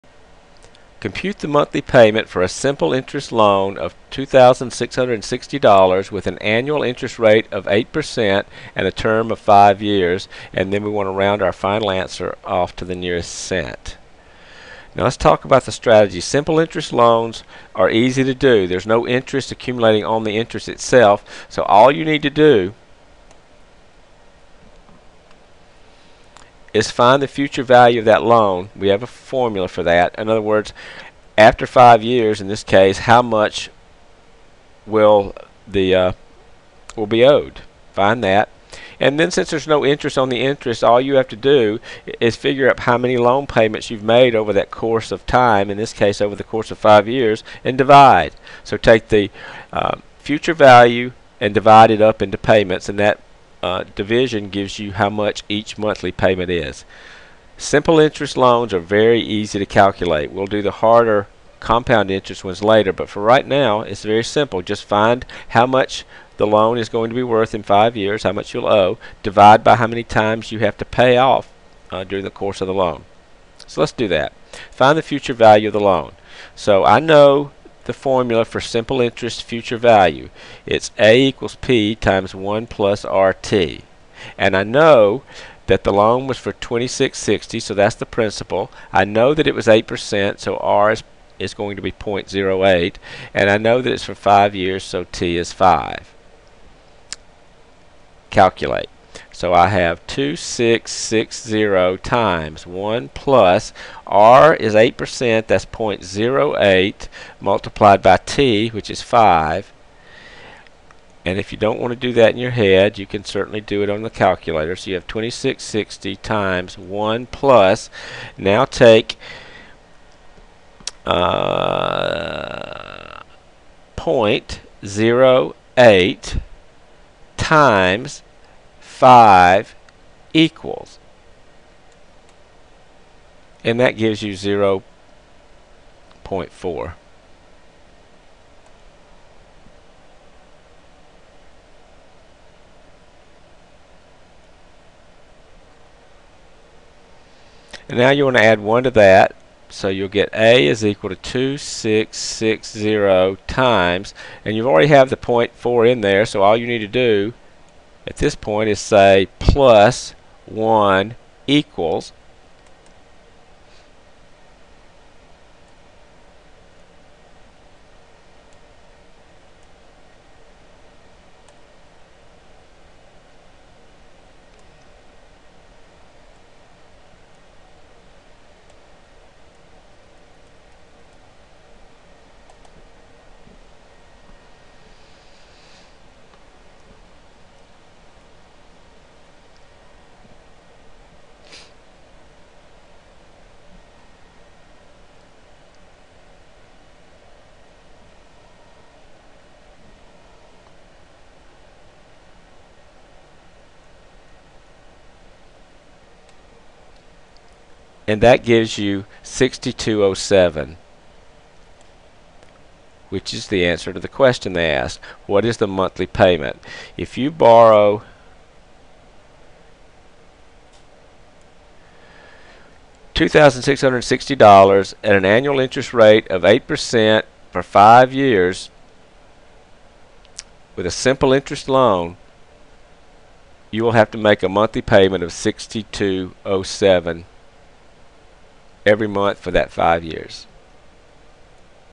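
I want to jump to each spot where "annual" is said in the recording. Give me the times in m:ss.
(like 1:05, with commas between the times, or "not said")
0:06, 3:45.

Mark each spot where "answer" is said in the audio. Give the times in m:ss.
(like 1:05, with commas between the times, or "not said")
0:11, 3:33.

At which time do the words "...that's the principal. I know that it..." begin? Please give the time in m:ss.
1:27.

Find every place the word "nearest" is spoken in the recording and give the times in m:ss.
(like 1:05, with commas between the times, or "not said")
0:12.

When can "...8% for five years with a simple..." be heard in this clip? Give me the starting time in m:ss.
3:46.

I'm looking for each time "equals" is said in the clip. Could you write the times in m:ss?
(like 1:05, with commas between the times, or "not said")
1:21, 2:10, 2:30, 2:41.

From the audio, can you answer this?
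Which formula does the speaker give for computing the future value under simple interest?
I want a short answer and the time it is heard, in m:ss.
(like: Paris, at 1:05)
A = P(1 + RT), at 1:20.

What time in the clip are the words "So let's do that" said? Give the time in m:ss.
1:13.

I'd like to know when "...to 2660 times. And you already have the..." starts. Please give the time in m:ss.
2:31.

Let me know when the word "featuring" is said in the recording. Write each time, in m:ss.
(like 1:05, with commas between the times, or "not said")
not said.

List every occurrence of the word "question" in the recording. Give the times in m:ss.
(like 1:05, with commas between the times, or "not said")
3:34.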